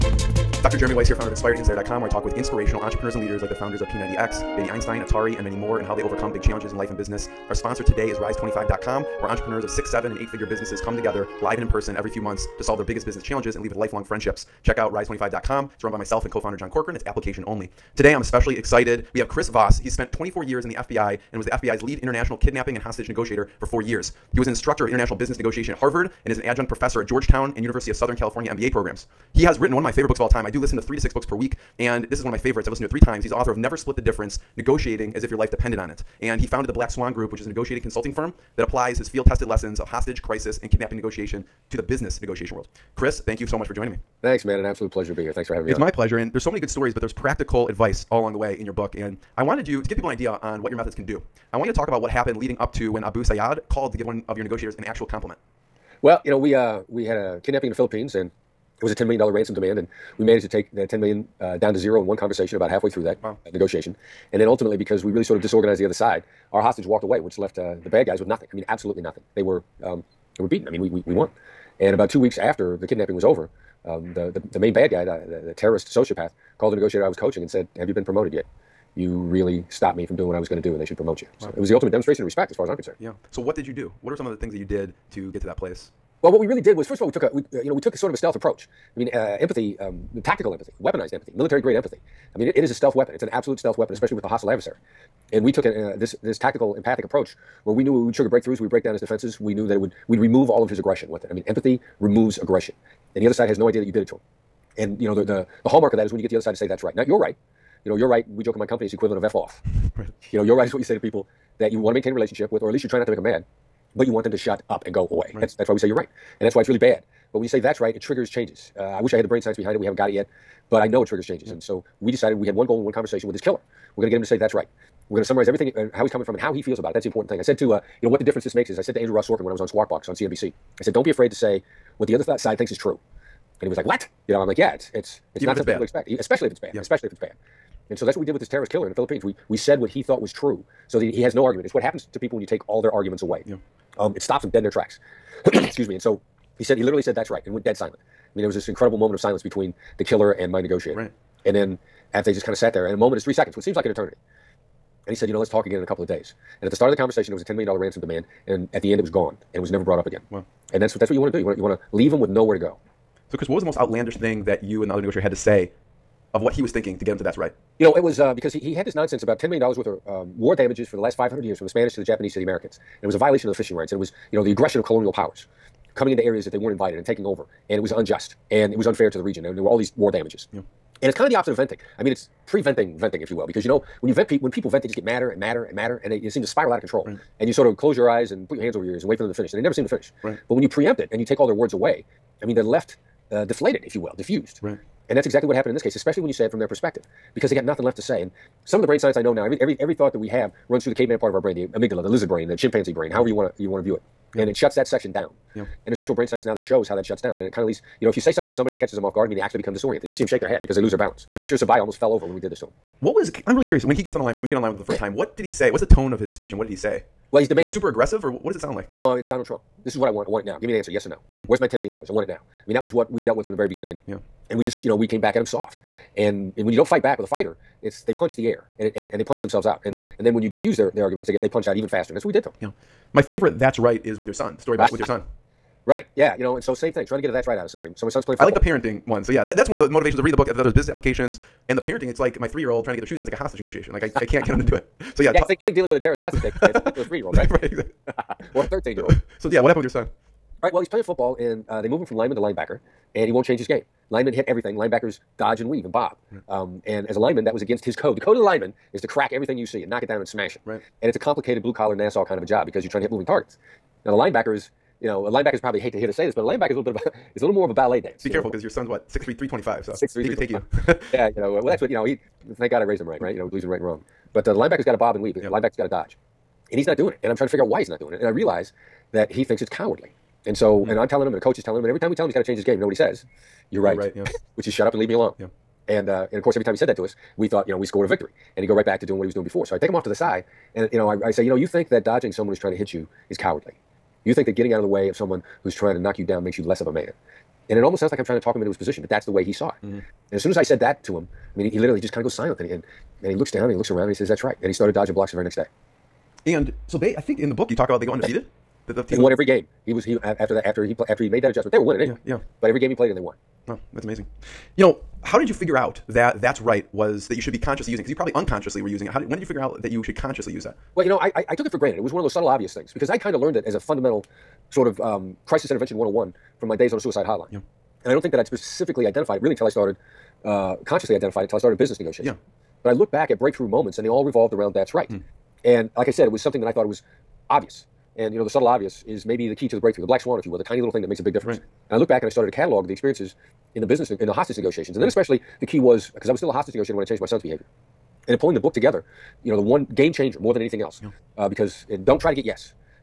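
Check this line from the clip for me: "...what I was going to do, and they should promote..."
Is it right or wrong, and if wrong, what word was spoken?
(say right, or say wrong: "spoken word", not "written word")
right.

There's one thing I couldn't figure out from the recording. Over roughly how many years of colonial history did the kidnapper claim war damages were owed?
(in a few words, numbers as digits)
500 years.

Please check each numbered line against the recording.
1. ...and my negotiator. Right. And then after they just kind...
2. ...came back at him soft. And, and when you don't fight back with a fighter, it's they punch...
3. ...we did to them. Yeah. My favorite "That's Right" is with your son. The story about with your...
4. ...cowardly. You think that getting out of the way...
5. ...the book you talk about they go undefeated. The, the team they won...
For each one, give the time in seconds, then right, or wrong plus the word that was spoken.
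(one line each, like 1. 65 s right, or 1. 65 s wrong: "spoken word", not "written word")
1. 150 s right
2. 225 s right
3. 232 s right
4. 293 s right
5. 307 s right.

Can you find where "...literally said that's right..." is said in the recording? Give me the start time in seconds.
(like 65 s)
146 s.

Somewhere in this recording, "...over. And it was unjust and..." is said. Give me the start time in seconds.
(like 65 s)
177 s.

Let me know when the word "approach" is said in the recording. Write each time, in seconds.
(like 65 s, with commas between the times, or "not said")
88 s, 97 s.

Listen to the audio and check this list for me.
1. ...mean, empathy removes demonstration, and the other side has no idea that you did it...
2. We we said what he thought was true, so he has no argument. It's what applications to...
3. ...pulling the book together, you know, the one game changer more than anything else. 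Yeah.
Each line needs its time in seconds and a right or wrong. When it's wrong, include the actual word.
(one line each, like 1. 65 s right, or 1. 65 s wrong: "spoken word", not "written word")
1. 101 s wrong: "aggression", not "demonstration"
2. 139 s wrong: "happens", not "applications"
3. 348 s right.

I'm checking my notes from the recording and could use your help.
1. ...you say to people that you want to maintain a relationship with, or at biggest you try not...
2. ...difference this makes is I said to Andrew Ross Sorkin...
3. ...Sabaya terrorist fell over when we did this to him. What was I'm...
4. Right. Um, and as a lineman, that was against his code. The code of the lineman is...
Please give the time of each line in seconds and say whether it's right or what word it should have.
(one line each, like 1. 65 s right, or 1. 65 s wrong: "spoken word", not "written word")
1. 110 s wrong: "least", not "biggest"
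2. 128 s right
3. 211 s wrong: "almost", not "terrorist"
4. 256 s right.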